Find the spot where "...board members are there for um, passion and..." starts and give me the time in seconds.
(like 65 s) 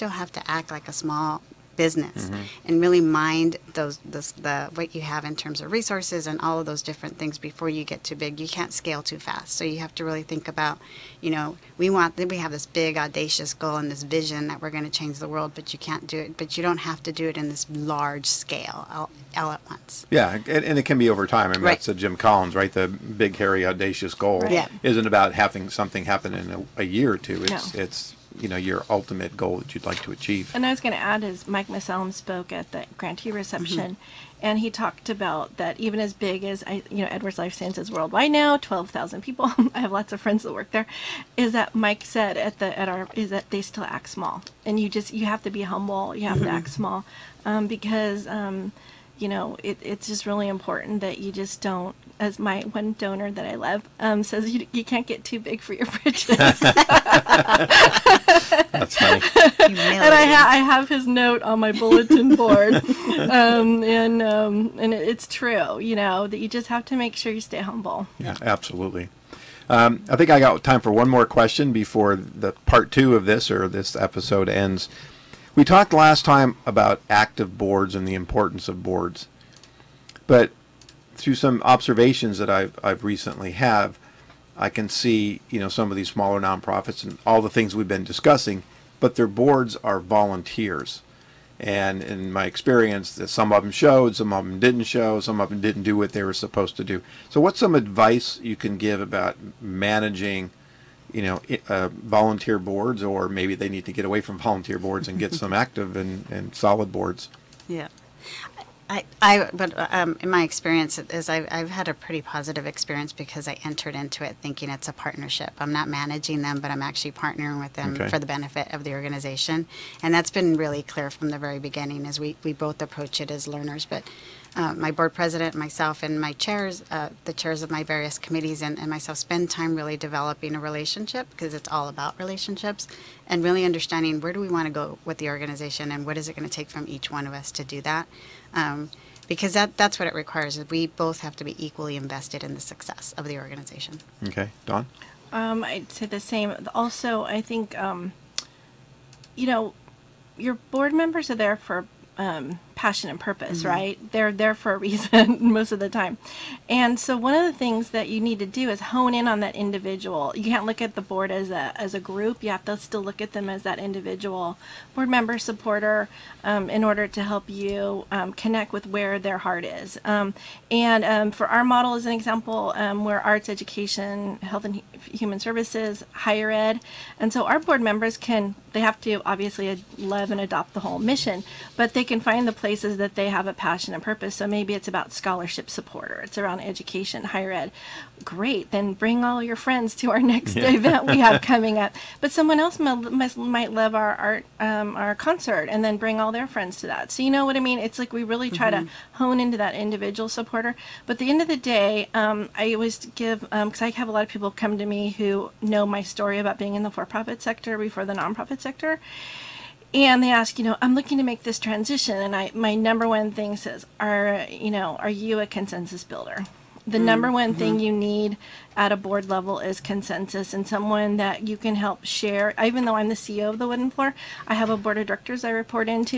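150 s.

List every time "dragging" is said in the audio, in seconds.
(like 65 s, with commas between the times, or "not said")
not said.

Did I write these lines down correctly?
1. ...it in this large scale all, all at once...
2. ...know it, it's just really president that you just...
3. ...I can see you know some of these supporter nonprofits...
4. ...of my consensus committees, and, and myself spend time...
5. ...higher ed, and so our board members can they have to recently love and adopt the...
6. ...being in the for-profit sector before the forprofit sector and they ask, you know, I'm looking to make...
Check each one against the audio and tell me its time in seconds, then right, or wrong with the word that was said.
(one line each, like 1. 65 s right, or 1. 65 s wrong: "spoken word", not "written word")
1. 17 s right
2. 49 s wrong: "important", not "president"
3. 84 s wrong: "smaller", not "supporter"
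4. 127 s wrong: "various", not "consensus"
5. 176 s wrong: "obviously", not "recently"
6. 206 s wrong: "nonprofit", not "forprofit".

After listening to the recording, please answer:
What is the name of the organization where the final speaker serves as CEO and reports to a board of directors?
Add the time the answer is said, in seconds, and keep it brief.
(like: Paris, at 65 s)
The Wooden Floor, at 223 s.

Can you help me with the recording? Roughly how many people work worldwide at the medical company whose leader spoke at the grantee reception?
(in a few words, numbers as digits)
12,000.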